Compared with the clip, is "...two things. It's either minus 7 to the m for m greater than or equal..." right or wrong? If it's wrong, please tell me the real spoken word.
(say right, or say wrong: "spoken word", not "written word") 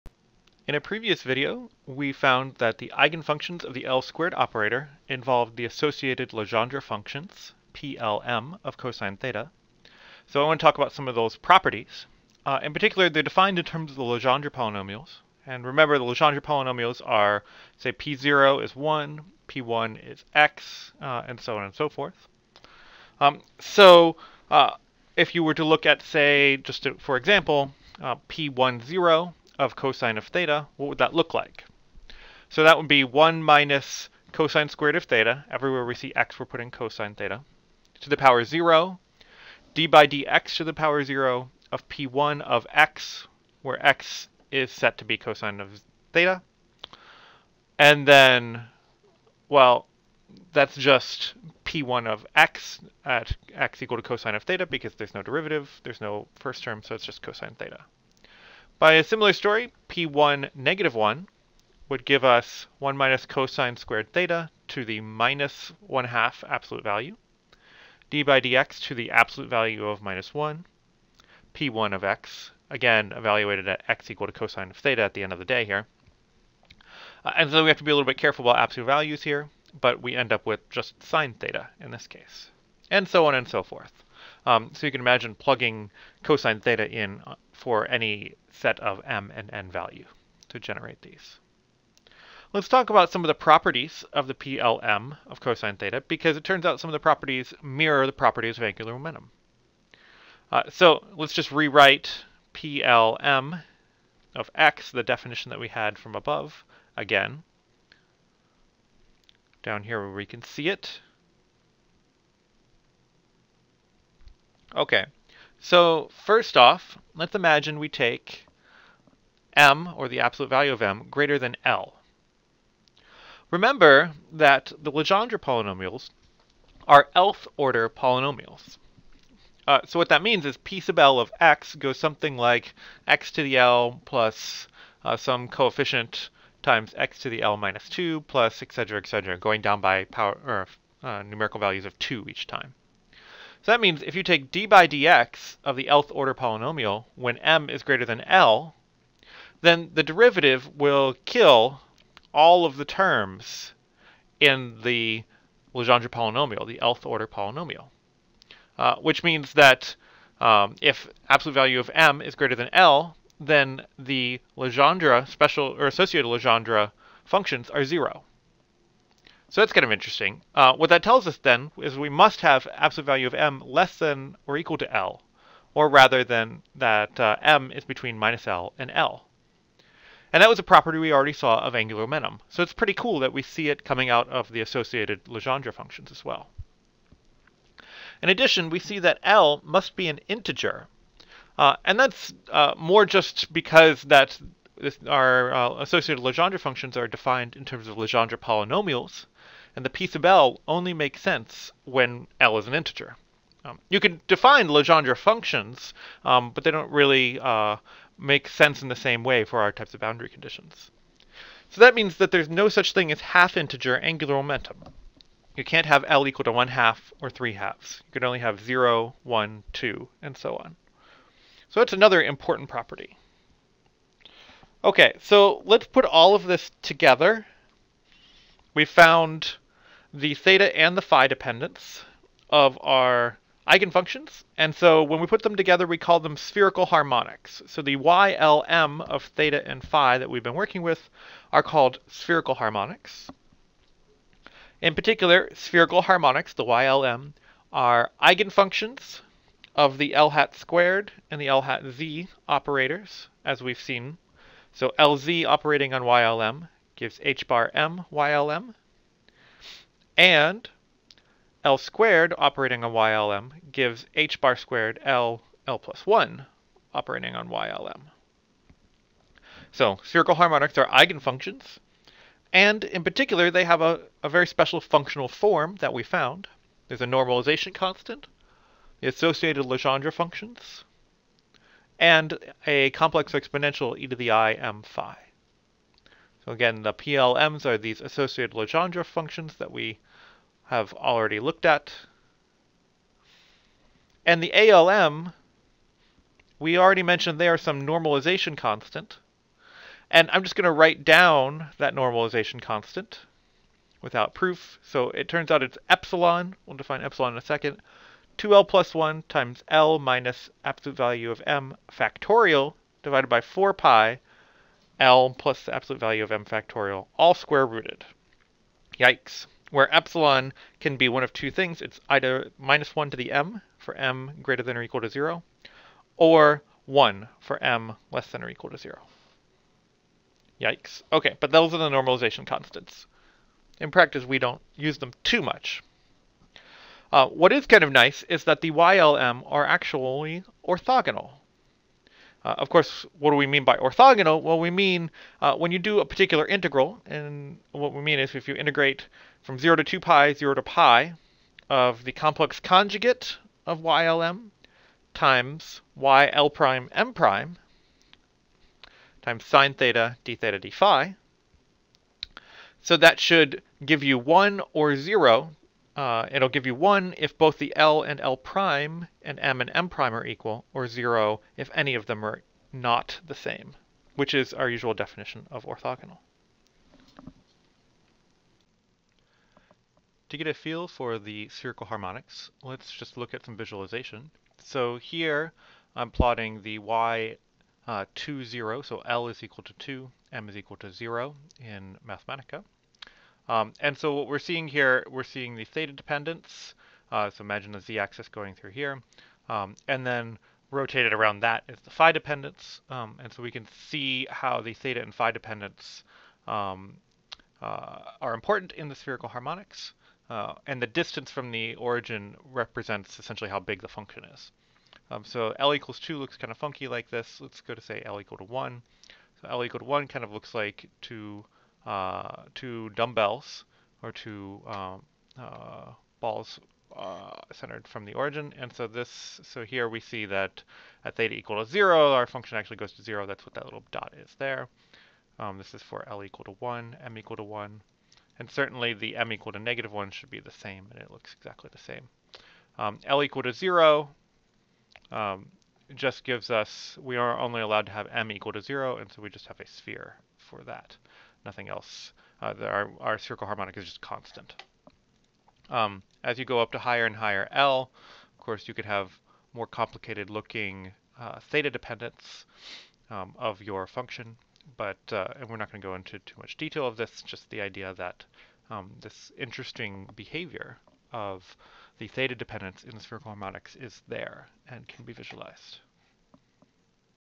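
wrong: "1", not "7".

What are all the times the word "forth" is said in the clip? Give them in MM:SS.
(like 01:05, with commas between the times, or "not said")
00:21, 01:23.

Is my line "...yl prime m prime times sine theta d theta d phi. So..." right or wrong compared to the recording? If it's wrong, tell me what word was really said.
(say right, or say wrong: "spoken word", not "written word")
right.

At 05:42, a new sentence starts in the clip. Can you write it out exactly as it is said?
Uh, of course, what do we mean by orthogonal?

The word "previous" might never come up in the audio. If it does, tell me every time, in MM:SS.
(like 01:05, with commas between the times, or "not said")
00:00.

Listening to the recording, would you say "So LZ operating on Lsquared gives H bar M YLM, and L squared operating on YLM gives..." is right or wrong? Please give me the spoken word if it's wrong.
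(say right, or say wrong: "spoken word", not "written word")
wrong: "YLM", not "Lsquared".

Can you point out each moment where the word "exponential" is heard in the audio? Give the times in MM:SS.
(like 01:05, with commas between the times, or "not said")
04:43.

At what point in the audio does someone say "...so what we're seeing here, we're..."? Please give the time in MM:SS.
06:33.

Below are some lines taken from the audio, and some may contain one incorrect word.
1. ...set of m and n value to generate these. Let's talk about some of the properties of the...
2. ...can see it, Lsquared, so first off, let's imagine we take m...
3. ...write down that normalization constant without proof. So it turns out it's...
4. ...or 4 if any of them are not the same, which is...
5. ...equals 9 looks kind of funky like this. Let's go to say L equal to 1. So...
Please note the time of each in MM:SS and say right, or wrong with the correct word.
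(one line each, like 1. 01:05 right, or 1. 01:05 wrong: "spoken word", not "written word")
1. 01:28 right
2. 01:50 wrong: "Okay", not "Lsquared"
3. 05:00 right
4. 06:10 wrong: "0", not "4"
5. 06:55 wrong: "2", not "9".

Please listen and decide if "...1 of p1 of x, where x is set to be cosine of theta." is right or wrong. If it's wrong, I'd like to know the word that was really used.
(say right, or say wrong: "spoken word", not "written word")
wrong: "0", not "1".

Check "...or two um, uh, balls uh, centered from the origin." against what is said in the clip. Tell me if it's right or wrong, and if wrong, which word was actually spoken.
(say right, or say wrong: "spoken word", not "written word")
right.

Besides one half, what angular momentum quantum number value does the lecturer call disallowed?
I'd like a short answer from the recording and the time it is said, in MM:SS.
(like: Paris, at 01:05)
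3 halves, at 03:37.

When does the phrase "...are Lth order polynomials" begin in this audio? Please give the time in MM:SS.
02:06.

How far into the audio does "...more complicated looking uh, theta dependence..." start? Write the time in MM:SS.
07:39.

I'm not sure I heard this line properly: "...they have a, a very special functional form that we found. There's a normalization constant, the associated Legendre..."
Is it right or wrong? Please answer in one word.
right.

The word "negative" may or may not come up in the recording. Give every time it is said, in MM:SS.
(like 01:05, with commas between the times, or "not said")
01:00, 07:19.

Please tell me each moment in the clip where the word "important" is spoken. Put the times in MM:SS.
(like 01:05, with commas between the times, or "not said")
03:42, 06:48.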